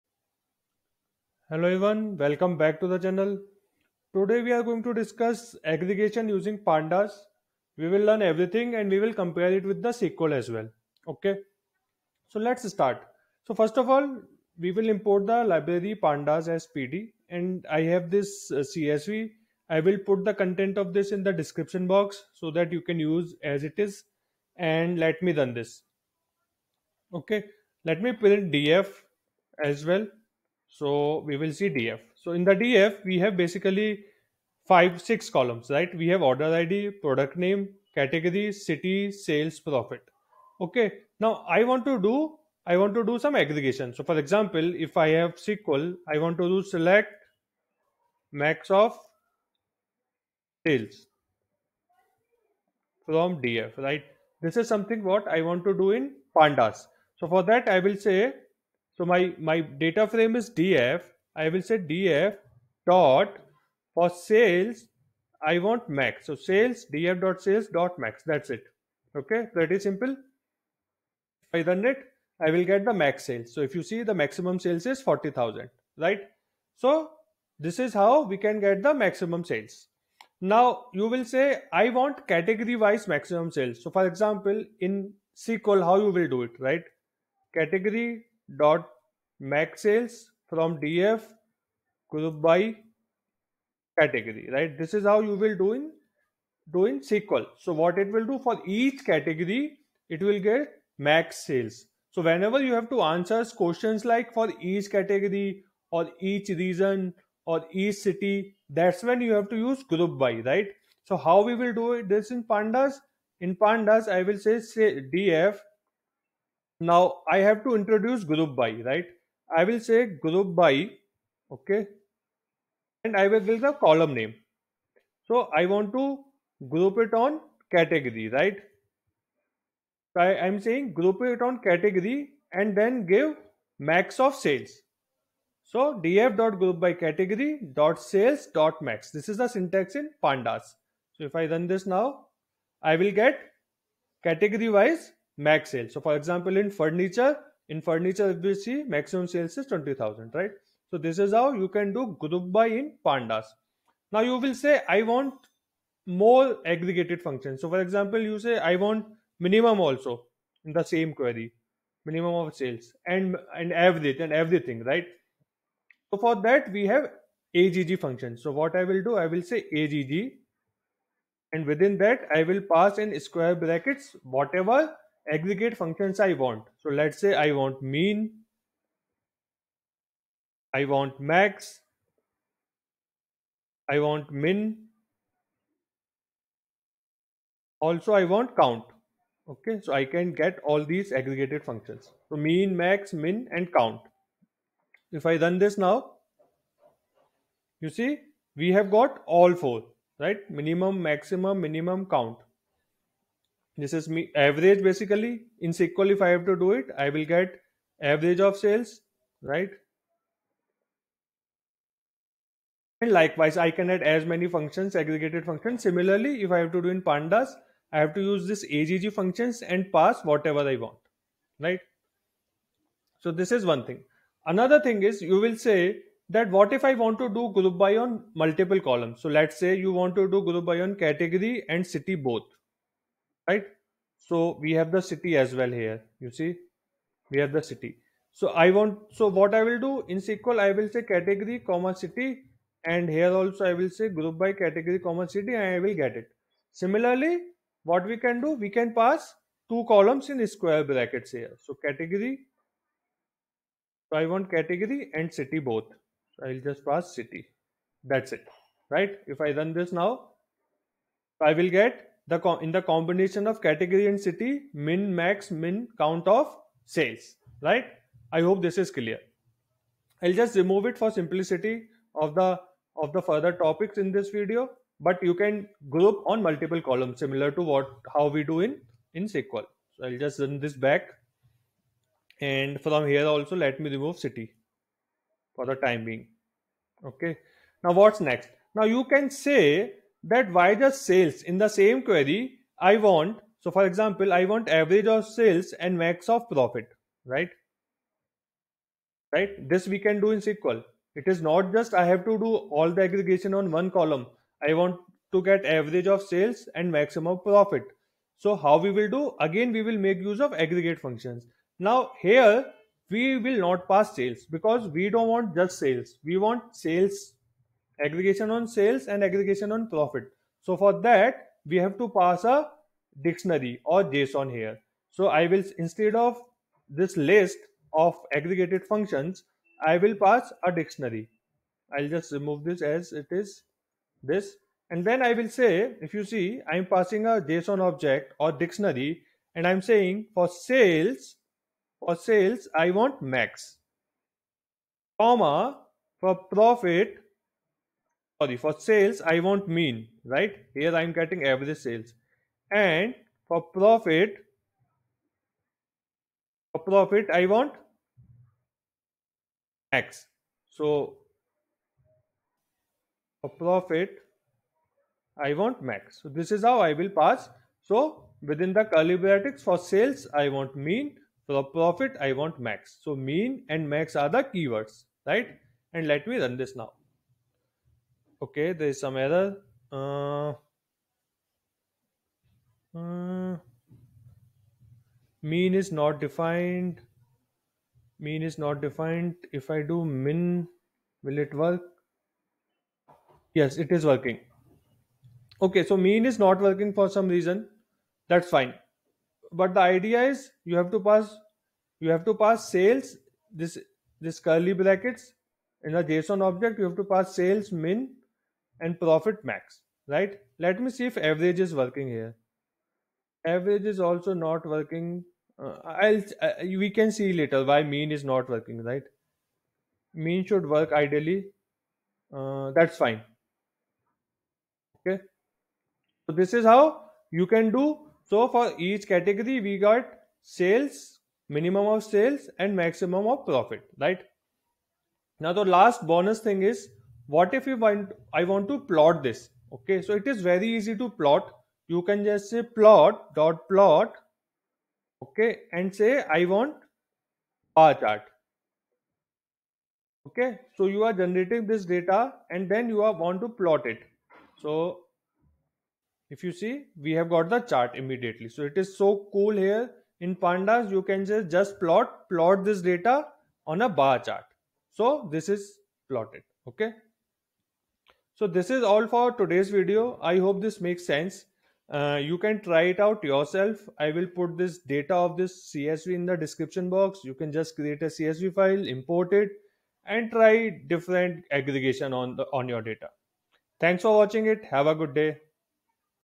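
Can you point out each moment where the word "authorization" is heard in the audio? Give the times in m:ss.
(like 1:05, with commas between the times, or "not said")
not said.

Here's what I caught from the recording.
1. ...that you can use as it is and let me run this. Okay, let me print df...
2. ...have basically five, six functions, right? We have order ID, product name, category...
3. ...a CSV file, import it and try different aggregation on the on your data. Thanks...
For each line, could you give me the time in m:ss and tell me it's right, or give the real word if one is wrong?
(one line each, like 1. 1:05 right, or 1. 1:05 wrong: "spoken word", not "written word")
1. 0:22 right
2. 0:33 wrong: "columns", not "functions"
3. 7:58 right.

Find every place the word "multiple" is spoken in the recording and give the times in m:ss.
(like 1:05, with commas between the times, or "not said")
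3:48, 4:36.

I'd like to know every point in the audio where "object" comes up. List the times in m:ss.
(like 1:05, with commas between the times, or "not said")
5:37, 6:46.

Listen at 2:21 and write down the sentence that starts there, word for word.
So if I run this now, I will get category wise max sale.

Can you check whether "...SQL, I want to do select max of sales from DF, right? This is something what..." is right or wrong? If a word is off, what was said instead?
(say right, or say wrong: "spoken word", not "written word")
right.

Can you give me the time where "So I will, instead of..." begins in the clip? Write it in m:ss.
5:25.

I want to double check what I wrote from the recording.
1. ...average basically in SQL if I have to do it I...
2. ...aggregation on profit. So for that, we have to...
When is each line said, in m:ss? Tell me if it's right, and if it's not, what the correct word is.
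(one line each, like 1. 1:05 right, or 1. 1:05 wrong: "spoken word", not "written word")
1. 3:24 right
2. 5:19 right.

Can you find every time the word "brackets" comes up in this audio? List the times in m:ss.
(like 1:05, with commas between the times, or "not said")
2:53, 4:10, 6:09, 6:44.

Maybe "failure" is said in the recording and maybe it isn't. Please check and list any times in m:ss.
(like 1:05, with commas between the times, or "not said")
not said.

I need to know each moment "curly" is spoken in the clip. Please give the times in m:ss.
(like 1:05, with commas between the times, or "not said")
6:08, 6:44.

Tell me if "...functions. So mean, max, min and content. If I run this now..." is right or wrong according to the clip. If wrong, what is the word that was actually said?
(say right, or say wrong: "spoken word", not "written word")
wrong: "count", not "content".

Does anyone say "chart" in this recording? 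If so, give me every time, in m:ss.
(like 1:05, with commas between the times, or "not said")
7:27, 7:37, 7:44.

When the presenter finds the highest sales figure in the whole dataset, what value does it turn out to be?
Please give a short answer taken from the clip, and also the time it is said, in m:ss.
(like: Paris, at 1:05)
40,000, at 1:15.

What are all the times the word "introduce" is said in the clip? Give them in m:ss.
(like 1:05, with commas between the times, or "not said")
1:57.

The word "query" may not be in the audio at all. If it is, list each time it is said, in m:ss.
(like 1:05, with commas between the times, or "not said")
2:41, 4:52.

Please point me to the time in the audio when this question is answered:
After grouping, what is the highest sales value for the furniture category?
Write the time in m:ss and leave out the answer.
2:29.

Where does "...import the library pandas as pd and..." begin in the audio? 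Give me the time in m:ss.
0:14.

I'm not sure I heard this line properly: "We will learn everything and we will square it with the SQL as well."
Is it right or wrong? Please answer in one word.
wrong.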